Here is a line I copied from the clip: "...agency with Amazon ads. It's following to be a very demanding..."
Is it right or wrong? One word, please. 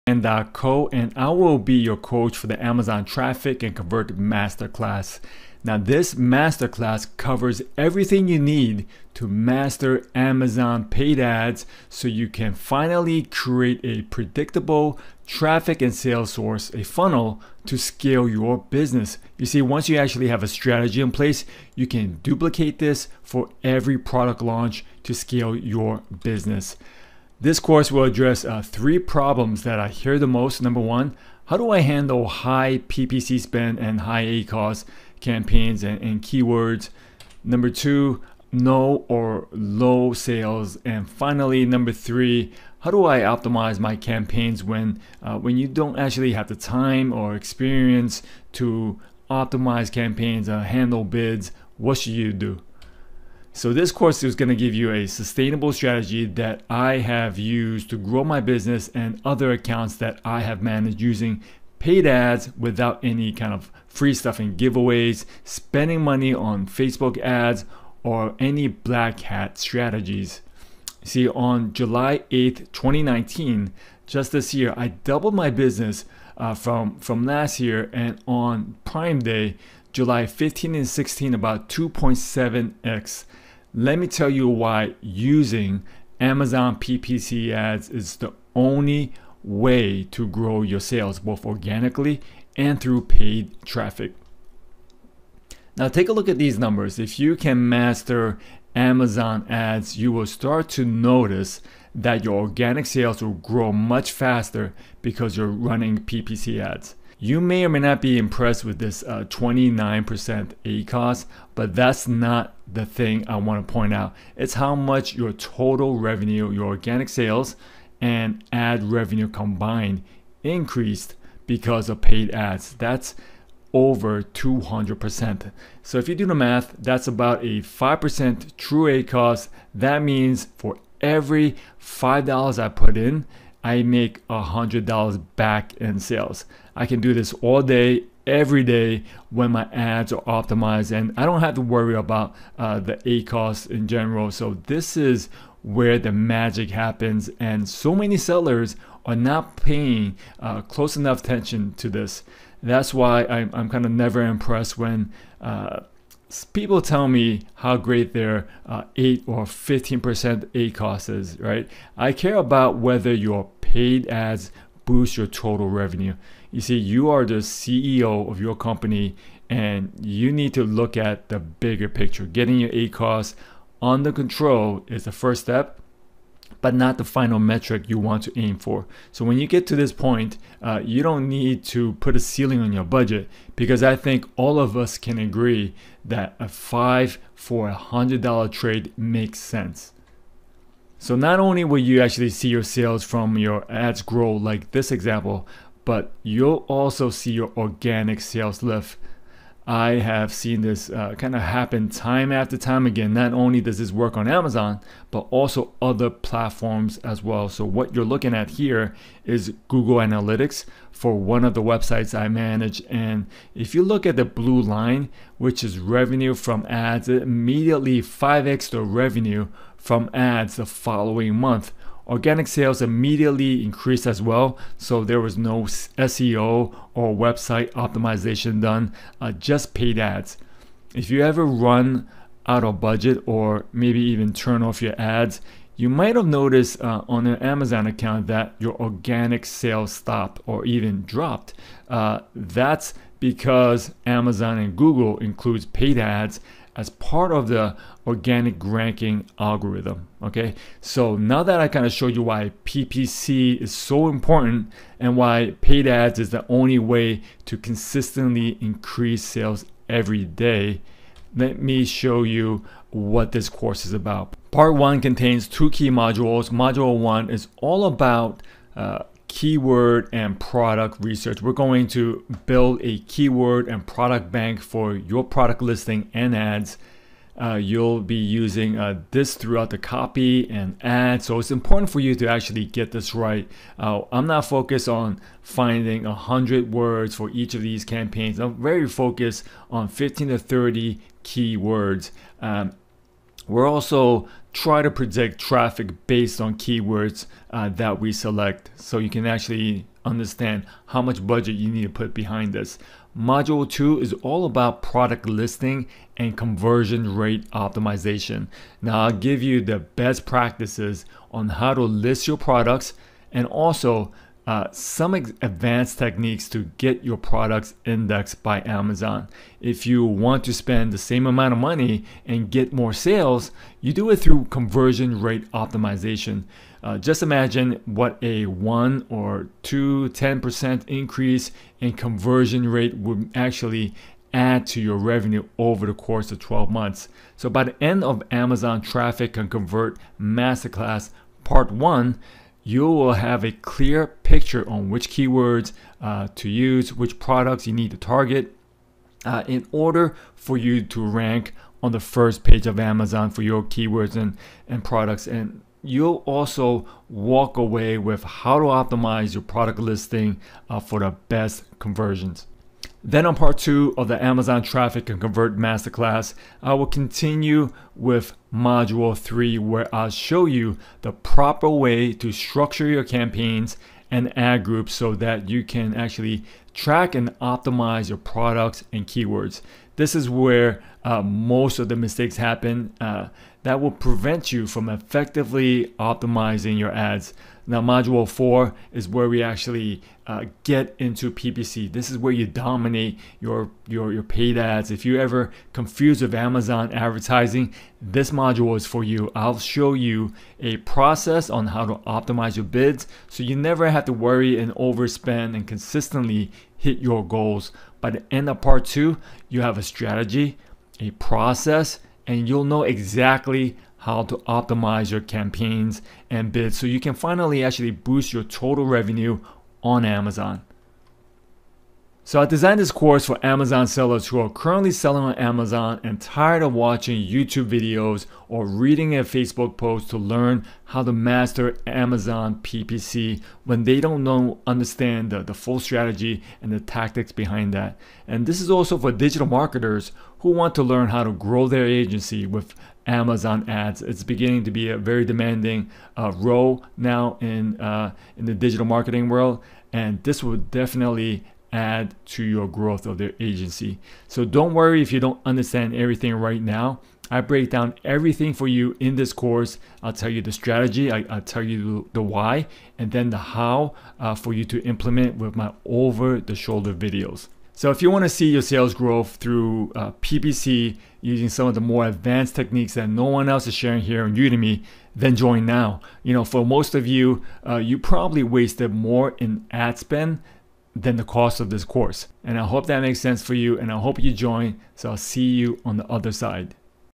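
wrong.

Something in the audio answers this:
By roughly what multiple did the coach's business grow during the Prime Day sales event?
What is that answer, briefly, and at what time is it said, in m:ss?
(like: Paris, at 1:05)
2.7x, at 1:21.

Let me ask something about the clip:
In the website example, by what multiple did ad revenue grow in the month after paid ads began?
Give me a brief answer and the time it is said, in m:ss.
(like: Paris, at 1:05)
5x, at 3:38.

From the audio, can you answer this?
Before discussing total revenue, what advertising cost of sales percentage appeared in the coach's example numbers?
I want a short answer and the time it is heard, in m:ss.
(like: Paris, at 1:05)
29%, at 1:49.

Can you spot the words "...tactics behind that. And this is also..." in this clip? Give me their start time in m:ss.
7:16.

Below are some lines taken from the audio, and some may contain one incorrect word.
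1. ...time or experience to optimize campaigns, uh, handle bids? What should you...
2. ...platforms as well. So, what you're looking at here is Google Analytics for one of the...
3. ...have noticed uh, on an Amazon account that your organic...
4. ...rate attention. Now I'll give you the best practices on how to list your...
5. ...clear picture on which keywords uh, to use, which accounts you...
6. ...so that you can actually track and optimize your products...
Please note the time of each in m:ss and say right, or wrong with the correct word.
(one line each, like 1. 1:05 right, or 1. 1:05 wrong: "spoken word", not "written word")
1. 0:46 right
2. 3:26 right
3. 3:56 right
4. 5:07 wrong: "optimization", not "attention"
5. 5:43 wrong: "products", not "accounts"
6. 6:14 right.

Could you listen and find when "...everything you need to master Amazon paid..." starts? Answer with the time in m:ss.
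0:07.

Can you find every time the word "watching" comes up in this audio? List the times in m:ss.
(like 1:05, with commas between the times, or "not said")
7:06.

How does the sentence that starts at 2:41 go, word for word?
I care about whether your paid ads boost your total revenue.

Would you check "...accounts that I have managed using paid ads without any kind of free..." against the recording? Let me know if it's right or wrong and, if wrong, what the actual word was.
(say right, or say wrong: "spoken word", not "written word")
right.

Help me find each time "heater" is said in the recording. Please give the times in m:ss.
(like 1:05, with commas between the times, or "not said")
not said.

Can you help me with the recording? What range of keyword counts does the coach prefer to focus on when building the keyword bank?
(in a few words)
15 to 30.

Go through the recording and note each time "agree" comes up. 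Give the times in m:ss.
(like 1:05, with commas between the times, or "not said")
3:05.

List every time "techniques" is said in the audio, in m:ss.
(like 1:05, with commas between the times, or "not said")
5:15, 7:52.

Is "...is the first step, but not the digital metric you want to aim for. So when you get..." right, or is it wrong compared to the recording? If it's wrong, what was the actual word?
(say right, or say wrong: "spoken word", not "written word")
wrong: "final", not "digital".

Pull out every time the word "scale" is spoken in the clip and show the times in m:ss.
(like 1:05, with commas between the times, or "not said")
0:17, 0:25.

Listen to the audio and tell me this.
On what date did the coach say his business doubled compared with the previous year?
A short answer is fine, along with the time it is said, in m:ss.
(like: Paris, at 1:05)
July 8th, 2019, at 1:11.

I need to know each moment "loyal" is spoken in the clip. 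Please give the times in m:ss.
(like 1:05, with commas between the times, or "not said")
not said.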